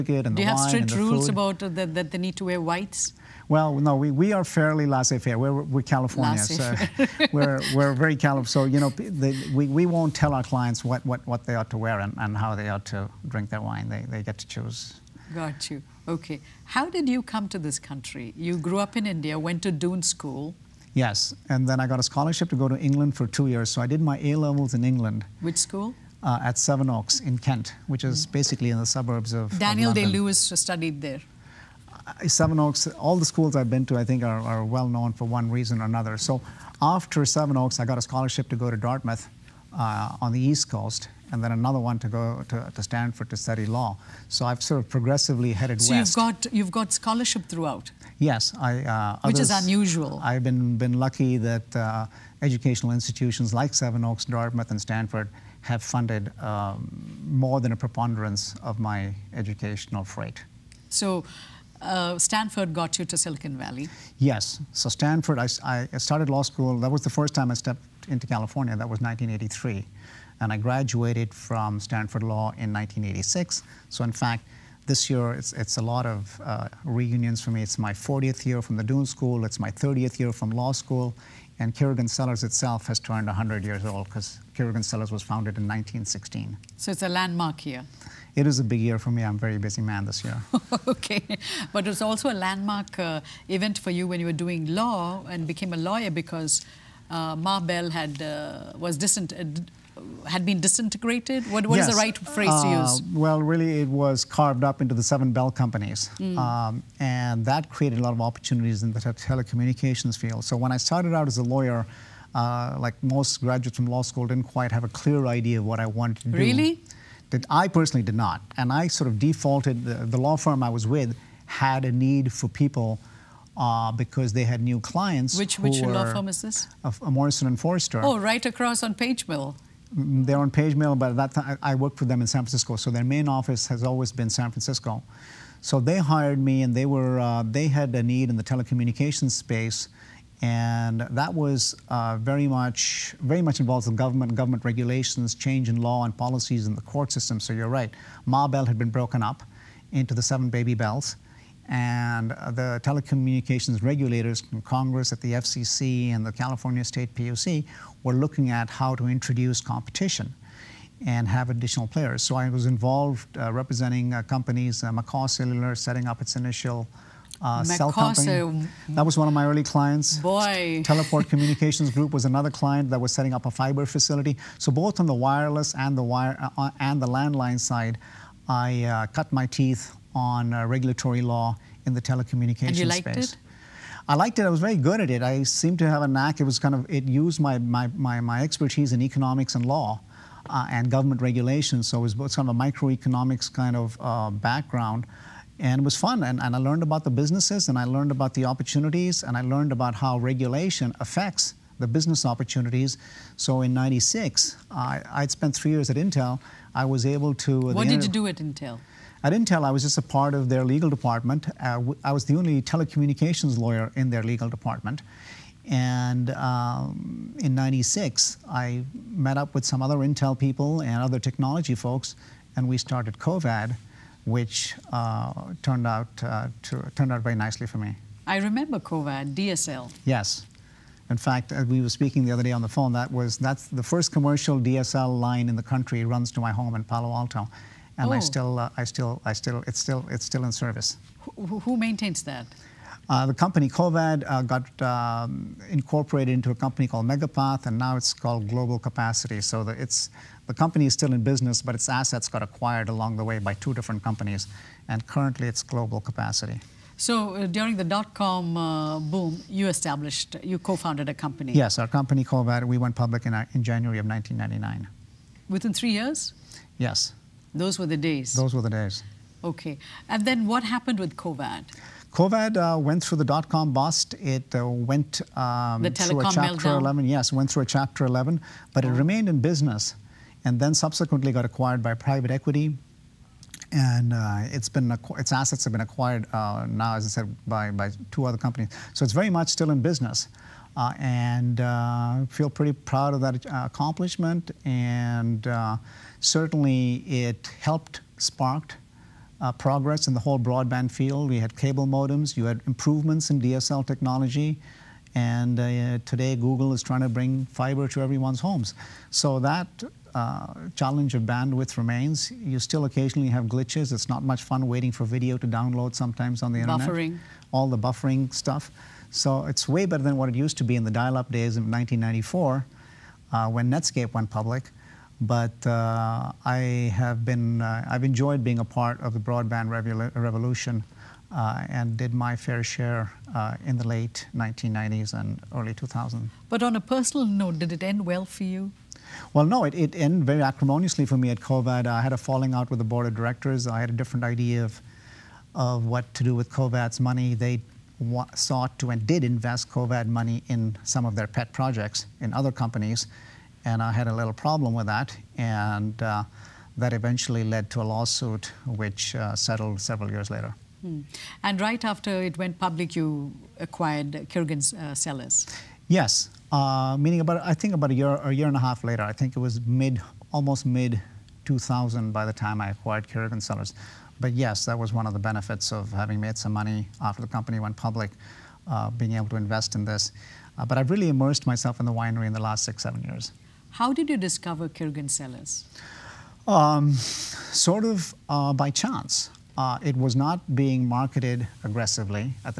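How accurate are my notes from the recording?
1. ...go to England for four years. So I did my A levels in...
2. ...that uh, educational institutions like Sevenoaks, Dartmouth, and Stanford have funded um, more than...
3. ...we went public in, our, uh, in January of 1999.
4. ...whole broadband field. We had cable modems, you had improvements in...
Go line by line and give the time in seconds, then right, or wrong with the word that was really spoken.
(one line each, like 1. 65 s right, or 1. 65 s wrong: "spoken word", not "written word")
1. 22 s wrong: "two", not "four"
2. 51 s right
3. 262 s right
4. 300 s right.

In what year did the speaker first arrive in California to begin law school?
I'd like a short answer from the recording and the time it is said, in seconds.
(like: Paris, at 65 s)
1983, at 68 s.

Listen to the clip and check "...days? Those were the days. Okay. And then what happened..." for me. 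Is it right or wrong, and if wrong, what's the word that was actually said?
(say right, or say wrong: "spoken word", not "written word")
right.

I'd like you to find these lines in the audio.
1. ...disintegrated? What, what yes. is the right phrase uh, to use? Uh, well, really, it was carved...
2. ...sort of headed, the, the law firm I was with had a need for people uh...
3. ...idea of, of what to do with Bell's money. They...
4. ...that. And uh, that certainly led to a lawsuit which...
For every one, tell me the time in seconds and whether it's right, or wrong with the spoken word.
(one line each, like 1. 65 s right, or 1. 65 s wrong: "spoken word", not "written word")
1. 100 s right
2. 118 s wrong: "defaulted", not "headed"
3. 344 s wrong: "COVAD", not "Bell"
4. 354 s wrong: "eventually", not "certainly".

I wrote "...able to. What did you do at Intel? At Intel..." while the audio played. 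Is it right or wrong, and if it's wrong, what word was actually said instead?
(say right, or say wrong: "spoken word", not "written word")
right.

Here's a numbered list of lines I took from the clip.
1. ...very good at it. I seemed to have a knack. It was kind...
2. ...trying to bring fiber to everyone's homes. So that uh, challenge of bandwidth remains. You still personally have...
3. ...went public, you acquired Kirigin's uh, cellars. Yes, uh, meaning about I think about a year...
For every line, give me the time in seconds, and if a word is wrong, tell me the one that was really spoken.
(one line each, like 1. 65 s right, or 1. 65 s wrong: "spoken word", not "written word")
1. 184 s right
2. 306 s wrong: "occasionally", not "personally"
3. 362 s right.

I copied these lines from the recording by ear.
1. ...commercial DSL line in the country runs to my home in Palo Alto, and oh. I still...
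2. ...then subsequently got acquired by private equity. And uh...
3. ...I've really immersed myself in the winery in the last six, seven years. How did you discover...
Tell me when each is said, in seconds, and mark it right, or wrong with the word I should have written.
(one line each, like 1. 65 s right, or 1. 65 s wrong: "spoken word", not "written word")
1. 234 s right
2. 280 s right
3. 380 s right.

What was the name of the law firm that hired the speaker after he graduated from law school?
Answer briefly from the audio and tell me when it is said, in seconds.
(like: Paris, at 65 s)
Morrison and Foerster, at 127 s.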